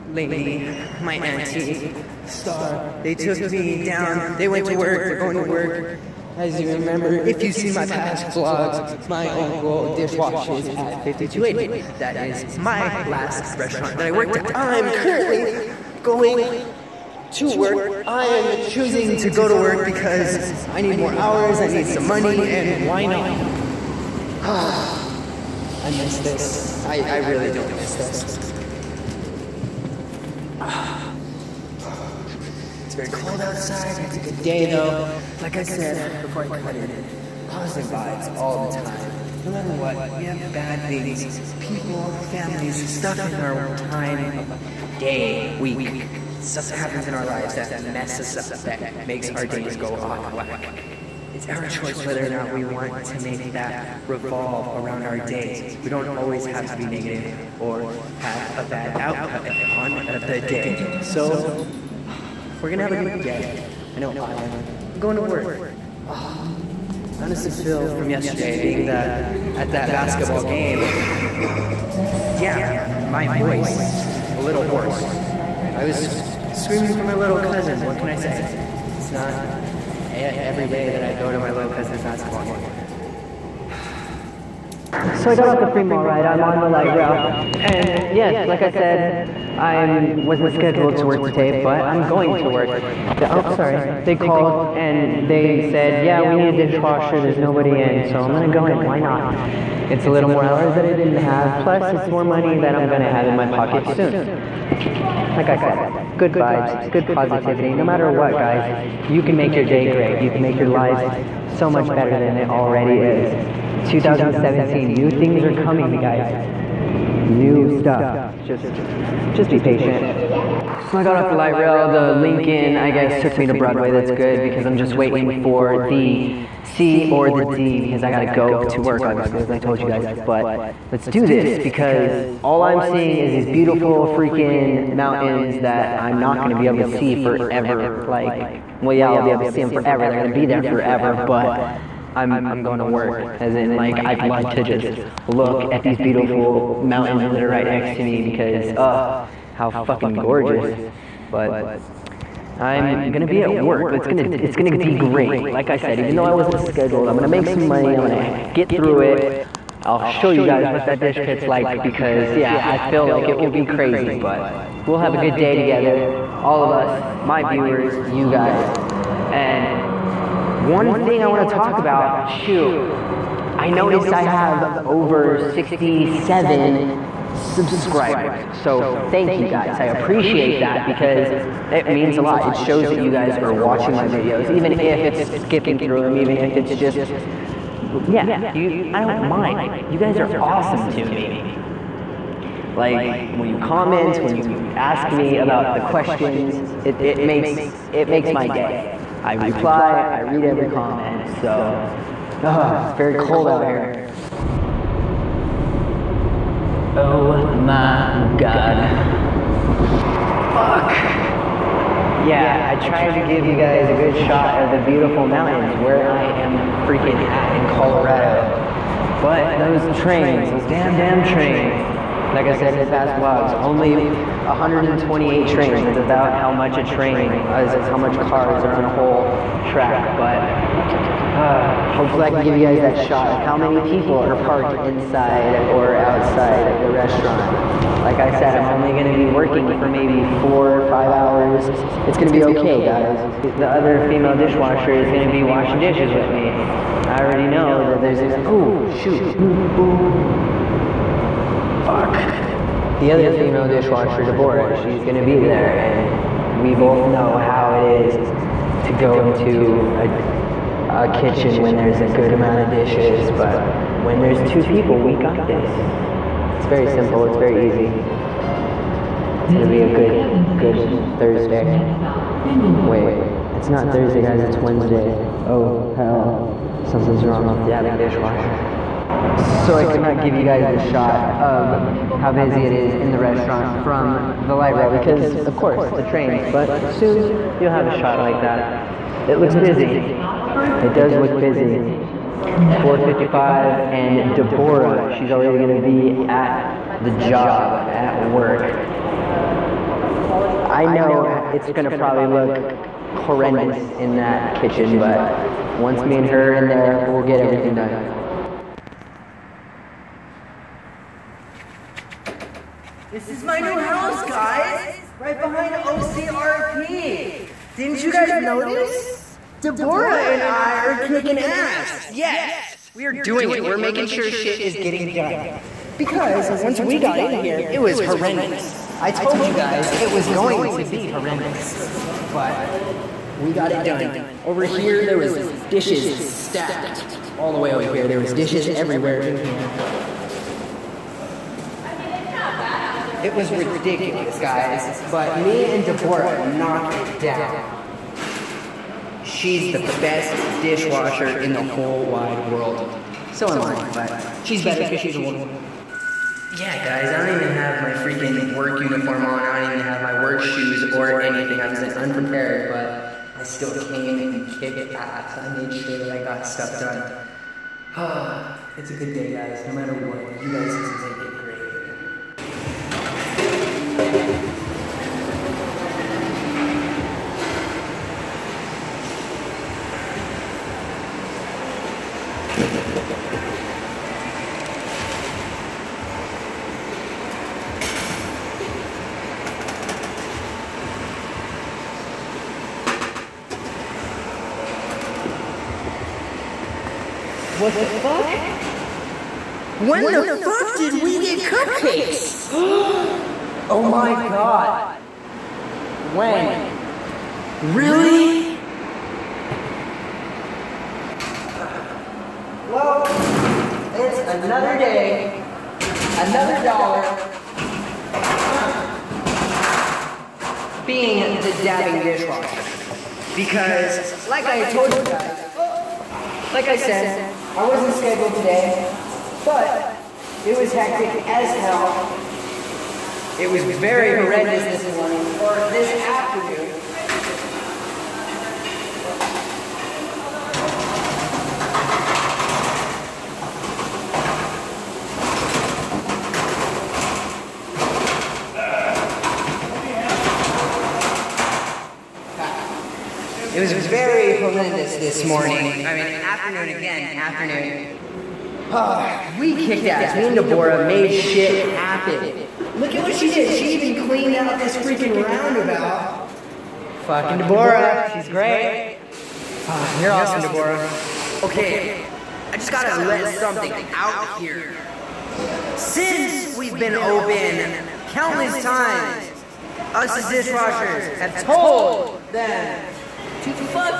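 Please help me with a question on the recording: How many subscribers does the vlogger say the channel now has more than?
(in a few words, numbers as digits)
67.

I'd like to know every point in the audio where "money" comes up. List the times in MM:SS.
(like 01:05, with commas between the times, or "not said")
00:22, 01:42, 02:37.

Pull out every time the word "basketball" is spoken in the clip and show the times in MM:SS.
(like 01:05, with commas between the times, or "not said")
01:09, 01:22.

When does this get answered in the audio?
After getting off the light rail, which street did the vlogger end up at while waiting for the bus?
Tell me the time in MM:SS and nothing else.
02:03.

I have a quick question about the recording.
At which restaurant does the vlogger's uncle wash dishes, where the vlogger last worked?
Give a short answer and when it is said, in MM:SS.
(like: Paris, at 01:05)
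5280, at 00:11.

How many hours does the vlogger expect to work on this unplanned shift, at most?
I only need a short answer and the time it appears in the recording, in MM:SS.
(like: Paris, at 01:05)
5, at 04:00.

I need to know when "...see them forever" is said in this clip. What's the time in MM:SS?
02:19.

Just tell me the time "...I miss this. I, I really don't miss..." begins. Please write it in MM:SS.
00:24.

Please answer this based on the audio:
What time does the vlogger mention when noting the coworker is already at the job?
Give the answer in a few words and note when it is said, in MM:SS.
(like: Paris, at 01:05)
4:55, at 04:52.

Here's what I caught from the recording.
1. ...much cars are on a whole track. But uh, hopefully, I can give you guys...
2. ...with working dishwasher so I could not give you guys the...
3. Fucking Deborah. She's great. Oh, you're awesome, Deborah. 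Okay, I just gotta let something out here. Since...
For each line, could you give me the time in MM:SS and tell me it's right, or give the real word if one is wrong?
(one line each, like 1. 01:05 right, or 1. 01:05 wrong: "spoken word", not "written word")
1. 03:47 right
2. 04:37 wrong: "dabbing", not "working"
3. 07:47 right.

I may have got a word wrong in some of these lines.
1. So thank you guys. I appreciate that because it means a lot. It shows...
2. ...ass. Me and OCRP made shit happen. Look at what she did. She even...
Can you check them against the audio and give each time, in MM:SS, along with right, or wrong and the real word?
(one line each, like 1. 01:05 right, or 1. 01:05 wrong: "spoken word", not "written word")
1. 02:58 right
2. 07:39 wrong: "Deborah", not "OCRP".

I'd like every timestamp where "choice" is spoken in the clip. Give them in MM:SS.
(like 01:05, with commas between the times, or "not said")
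00:51.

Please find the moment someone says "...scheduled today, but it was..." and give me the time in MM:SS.
07:07.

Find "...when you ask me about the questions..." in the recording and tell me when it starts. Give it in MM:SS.
03:14.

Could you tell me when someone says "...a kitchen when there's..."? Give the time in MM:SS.
04:21.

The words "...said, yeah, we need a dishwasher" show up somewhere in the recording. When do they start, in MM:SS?
01:35.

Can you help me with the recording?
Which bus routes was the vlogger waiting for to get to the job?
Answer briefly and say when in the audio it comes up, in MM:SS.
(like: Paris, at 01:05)
The C or the D, at 02:05.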